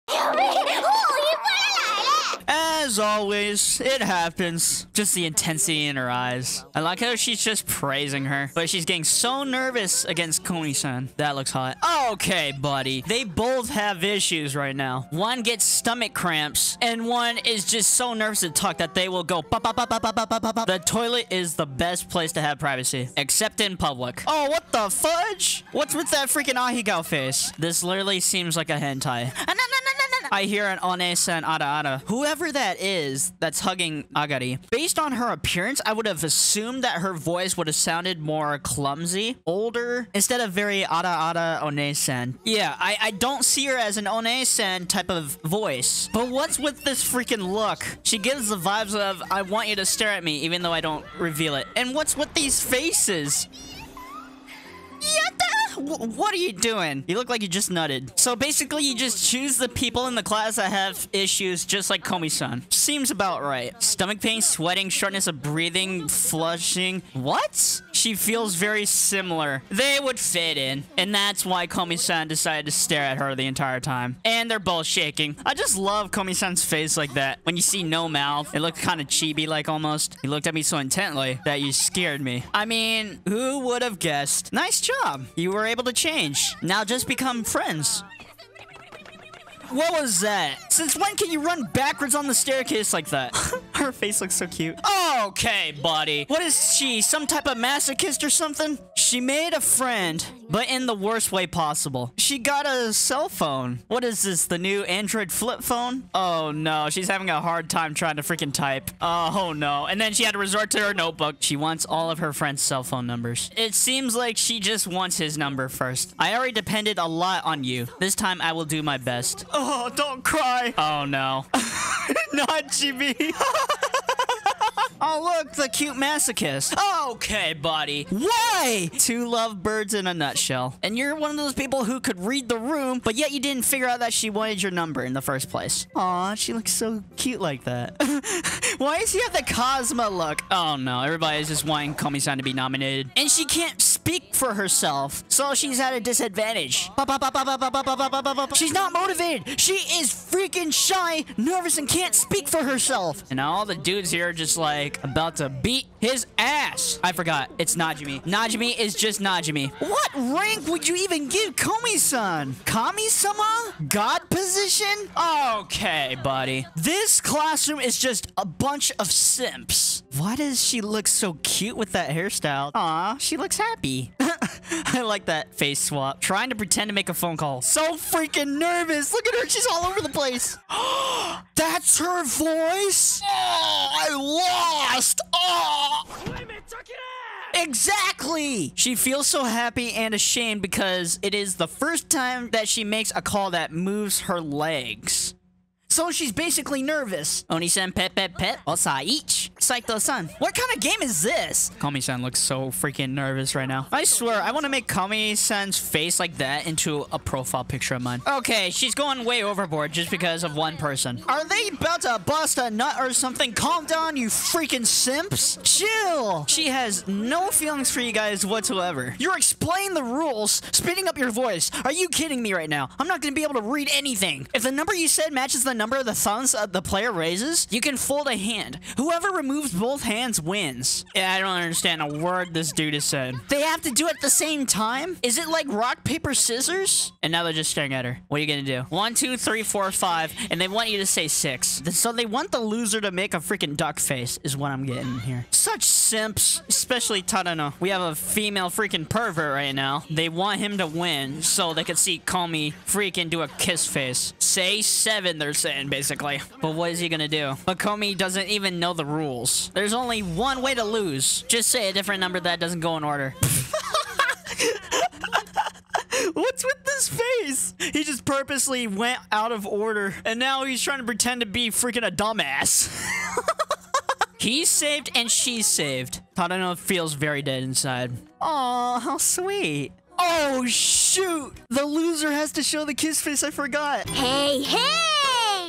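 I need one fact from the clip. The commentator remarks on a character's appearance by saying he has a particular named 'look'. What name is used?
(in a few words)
Cosmo.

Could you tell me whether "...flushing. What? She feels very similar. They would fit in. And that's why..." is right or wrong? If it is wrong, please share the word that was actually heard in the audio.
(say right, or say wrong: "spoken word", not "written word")
right.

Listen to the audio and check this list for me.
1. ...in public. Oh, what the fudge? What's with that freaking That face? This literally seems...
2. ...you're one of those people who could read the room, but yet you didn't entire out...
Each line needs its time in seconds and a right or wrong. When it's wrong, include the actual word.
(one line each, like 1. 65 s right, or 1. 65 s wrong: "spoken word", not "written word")
1. 23 s wrong: "Ahegao", not "That"
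2. 130 s wrong: "figure", not "entire".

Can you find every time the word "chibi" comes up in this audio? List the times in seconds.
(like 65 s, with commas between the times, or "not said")
79 s, 122 s.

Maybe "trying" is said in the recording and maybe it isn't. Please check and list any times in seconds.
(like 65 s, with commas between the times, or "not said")
107 s, 176 s, 270 s.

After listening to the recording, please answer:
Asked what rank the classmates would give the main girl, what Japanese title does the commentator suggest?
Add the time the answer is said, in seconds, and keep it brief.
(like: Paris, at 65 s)
Kami-sama, at 162 s.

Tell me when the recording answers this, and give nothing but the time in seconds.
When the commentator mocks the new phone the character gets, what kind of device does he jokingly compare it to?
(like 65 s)
104 s.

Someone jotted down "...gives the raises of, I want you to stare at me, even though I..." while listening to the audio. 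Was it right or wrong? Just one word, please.
wrong.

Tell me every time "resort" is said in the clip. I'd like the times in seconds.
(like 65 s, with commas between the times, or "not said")
110 s.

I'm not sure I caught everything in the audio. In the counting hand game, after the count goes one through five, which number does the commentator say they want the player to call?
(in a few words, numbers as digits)
6.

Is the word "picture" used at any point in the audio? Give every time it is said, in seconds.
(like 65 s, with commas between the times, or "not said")
207 s.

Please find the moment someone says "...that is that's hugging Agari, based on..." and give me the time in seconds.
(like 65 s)
32 s.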